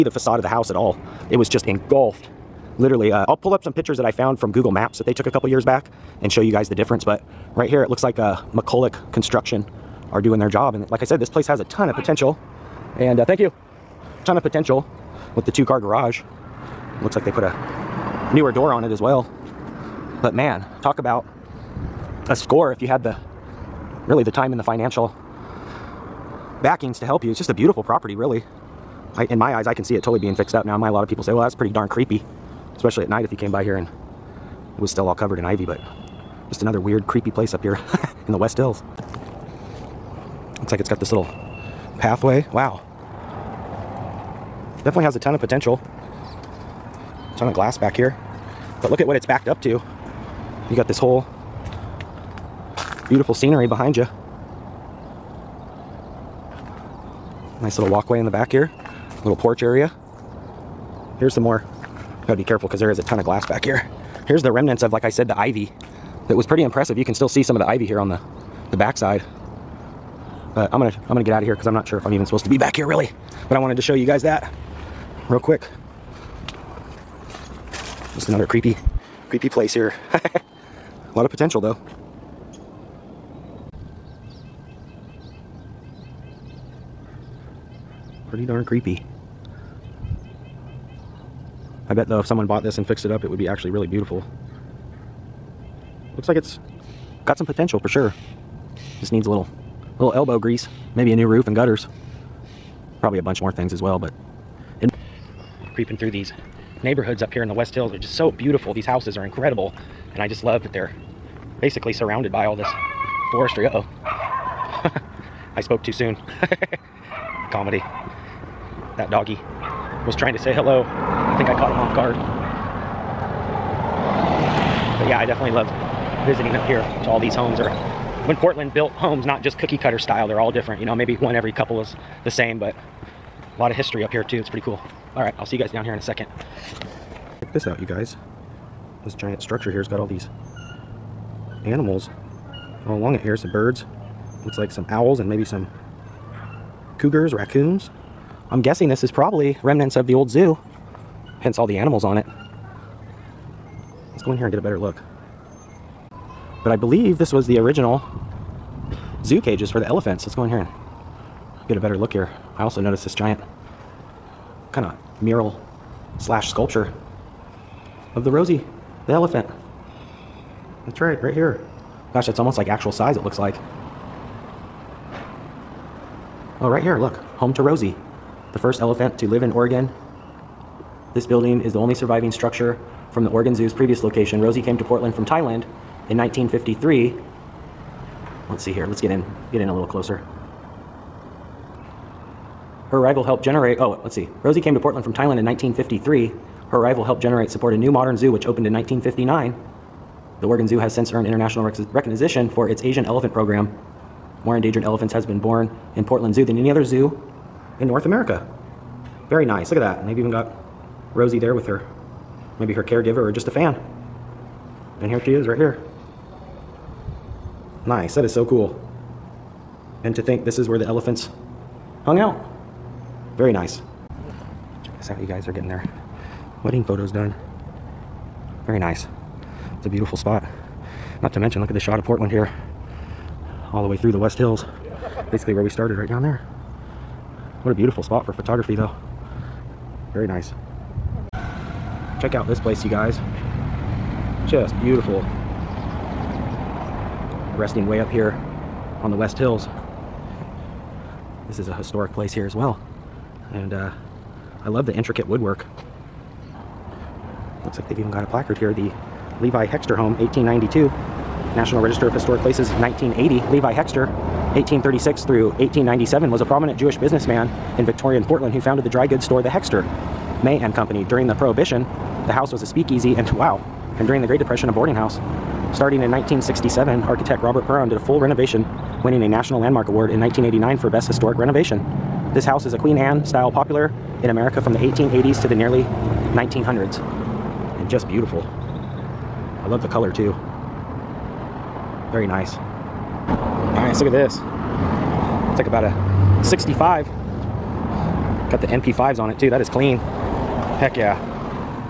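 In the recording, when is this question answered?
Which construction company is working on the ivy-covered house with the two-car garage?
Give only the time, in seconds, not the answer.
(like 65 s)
8 s.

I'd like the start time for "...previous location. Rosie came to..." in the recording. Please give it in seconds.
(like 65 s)
183 s.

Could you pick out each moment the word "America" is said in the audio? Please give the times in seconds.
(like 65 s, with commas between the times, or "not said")
208 s, 284 s.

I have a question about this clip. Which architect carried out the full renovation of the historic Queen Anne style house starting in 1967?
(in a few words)
Robert Perron.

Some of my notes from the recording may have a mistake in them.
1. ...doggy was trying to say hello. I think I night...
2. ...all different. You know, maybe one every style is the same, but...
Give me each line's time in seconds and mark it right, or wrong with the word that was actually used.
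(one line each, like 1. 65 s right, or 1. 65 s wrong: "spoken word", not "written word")
1. 119 s wrong: "caught", not "night"
2. 130 s wrong: "couple", not "style".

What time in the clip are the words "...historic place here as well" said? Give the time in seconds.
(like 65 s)
251 s.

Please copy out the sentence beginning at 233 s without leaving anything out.
All the way through the West Hills.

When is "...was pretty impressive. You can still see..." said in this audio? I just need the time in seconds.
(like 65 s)
66 s.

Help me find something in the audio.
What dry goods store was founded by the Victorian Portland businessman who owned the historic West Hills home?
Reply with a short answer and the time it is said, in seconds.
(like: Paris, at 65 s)
The Hexter, May and Company, at 269 s.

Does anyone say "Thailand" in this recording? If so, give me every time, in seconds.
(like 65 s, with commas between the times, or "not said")
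185 s, 195 s.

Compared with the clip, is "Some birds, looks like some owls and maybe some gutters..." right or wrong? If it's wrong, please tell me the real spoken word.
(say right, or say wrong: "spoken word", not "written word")
wrong: "cougars", not "gutters".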